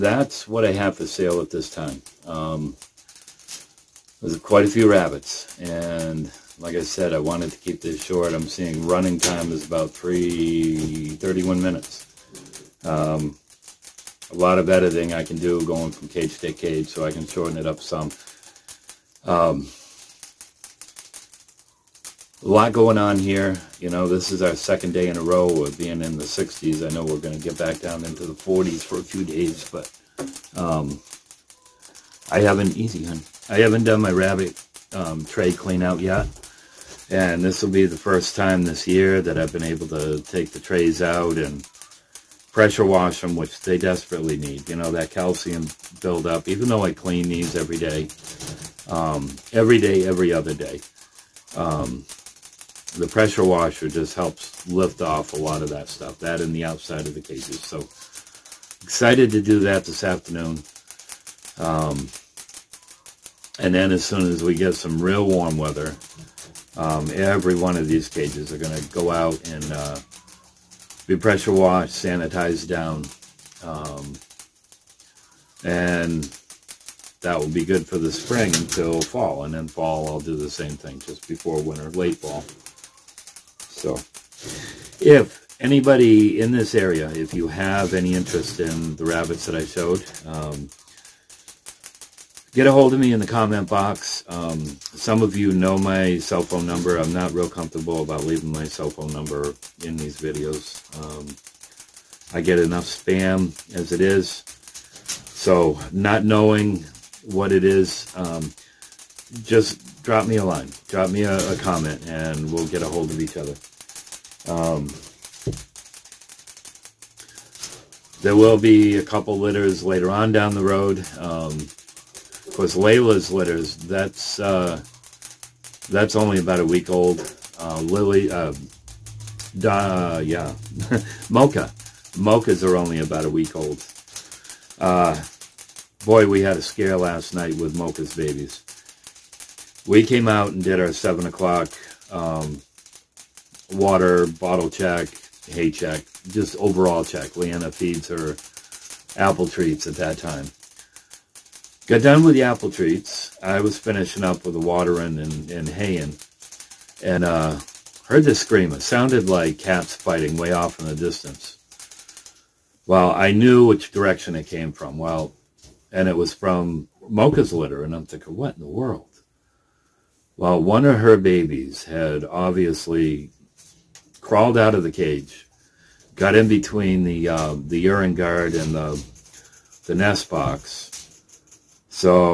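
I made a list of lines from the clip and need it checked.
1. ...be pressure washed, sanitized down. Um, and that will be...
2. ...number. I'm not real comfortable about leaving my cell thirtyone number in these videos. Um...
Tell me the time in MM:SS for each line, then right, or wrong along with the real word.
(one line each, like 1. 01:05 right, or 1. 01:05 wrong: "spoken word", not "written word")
1. 01:11 right
2. 01:36 wrong: "phone", not "thirtyone".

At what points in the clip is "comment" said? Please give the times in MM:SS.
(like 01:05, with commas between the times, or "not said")
01:33, 01:51.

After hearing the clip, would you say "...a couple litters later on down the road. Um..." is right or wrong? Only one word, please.
right.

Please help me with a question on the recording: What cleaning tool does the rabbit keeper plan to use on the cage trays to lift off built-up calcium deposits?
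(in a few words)
pressure washer.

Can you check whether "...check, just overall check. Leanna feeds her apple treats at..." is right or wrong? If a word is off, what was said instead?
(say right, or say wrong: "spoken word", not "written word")
right.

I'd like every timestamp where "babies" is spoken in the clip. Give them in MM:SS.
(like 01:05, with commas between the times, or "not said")
02:18, 02:51.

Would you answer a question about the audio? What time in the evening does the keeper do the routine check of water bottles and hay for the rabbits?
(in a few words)
7 o'clock.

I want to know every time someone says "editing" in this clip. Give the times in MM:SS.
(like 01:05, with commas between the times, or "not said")
00:14.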